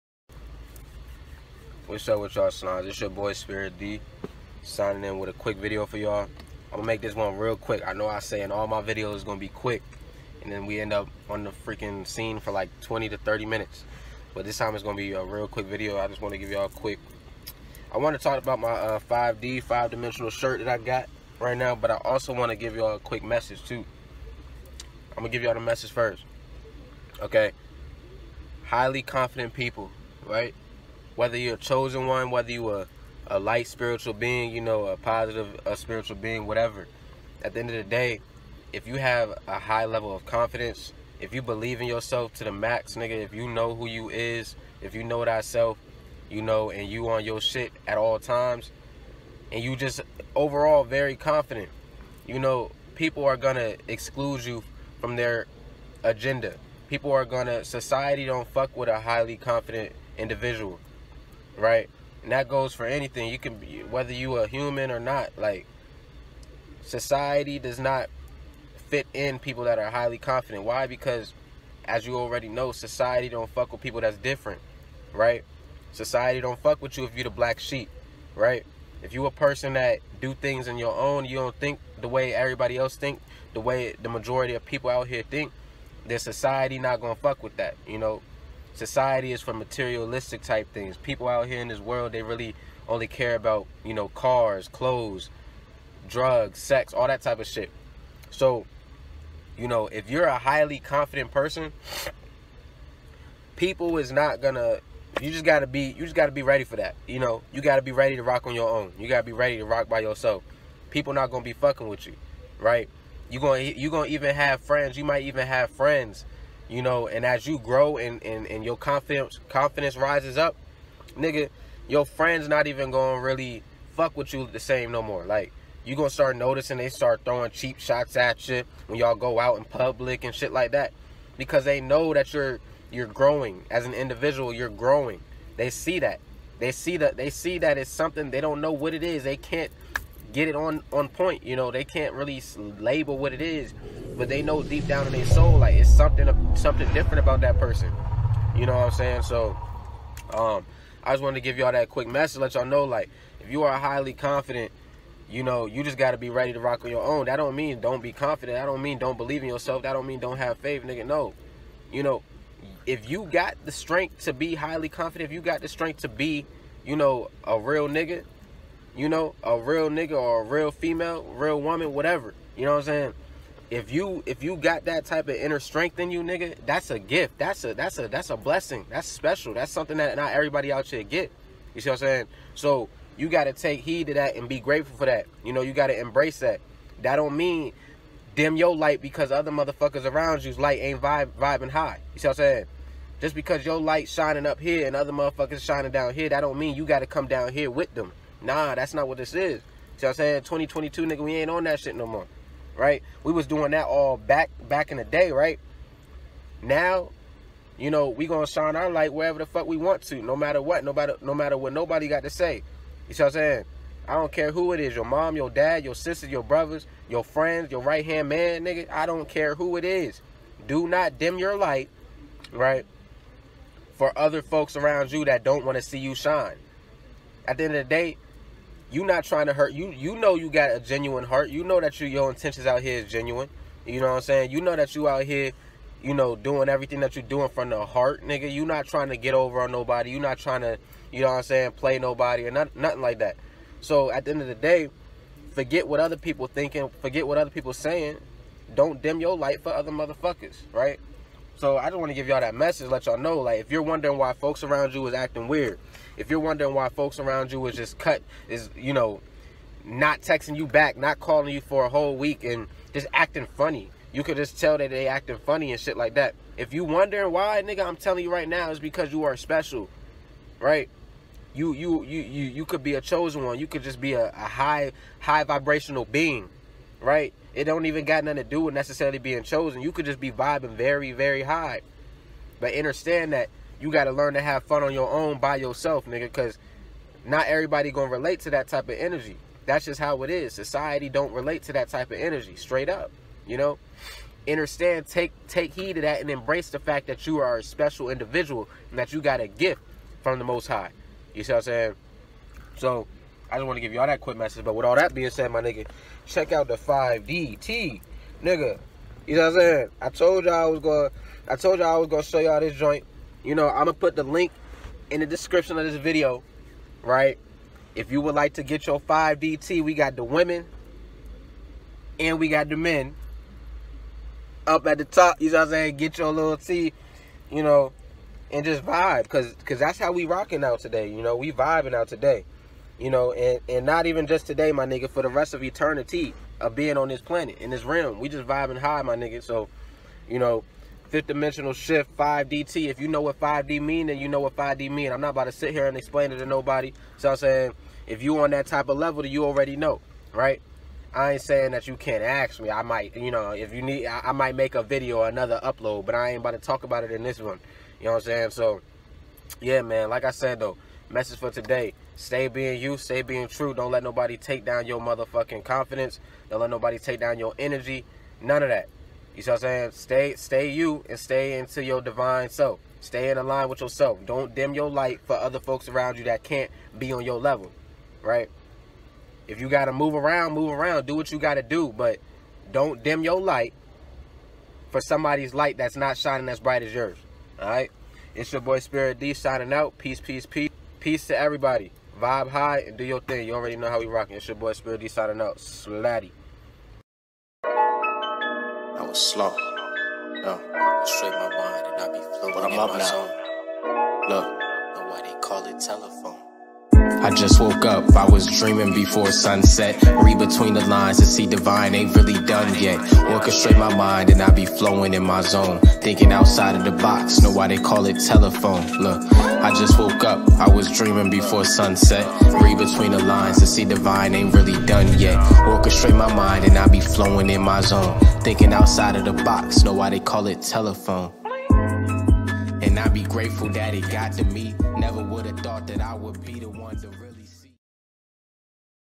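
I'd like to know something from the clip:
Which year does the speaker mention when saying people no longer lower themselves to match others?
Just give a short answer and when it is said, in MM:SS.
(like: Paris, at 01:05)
2022, at 03:20.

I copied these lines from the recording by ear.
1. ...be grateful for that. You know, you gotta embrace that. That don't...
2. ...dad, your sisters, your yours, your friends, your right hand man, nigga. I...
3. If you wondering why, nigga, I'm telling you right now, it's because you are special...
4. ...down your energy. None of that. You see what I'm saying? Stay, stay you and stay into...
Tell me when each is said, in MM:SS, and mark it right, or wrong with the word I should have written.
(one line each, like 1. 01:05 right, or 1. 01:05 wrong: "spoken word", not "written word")
1. 03:04 right
2. 03:35 wrong: "brothers", not "yours"
3. 04:26 right
4. 06:07 right.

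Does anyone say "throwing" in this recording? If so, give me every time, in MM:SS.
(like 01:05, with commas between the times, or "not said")
02:07.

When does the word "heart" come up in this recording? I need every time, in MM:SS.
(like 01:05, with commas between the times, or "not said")
03:51, 03:57.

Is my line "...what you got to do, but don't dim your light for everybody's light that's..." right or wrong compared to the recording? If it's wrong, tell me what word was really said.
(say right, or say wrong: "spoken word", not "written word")
wrong: "somebody", not "everybody".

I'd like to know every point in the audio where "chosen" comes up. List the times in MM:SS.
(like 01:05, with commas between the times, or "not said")
00:31, 04:33, 04:39.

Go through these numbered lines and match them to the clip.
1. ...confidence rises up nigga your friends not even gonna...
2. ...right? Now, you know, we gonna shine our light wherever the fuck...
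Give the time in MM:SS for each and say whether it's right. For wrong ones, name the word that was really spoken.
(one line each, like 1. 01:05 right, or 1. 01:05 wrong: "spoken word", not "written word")
1. 01:59 right
2. 03:25 right.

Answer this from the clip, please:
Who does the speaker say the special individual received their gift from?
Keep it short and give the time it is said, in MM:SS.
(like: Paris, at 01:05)
the Most High, at 05:00.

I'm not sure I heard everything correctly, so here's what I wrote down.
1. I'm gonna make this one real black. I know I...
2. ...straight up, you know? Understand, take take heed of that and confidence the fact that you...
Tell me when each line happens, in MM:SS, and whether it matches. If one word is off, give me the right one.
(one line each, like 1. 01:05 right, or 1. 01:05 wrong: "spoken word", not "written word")
1. 00:06 wrong: "quick", not "black"
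2. 04:52 wrong: "embrace", not "confidence".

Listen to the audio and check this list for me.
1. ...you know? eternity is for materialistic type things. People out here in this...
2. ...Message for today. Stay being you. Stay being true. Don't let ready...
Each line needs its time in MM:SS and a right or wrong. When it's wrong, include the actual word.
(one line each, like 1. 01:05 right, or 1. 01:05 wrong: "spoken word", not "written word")
1. 01:27 wrong: "society", not "eternity"
2. 06:01 wrong: "nobody", not "ready".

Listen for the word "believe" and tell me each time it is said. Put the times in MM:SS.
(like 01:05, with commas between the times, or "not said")
00:41, 02:39.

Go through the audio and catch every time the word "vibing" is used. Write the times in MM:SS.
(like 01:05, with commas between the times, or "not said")
03:11, 04:40, 05:31, 05:38.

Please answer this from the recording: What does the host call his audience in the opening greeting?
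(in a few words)
Snobs.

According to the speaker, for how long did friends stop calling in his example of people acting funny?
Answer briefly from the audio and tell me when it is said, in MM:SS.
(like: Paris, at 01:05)
a whole week, at 04:21.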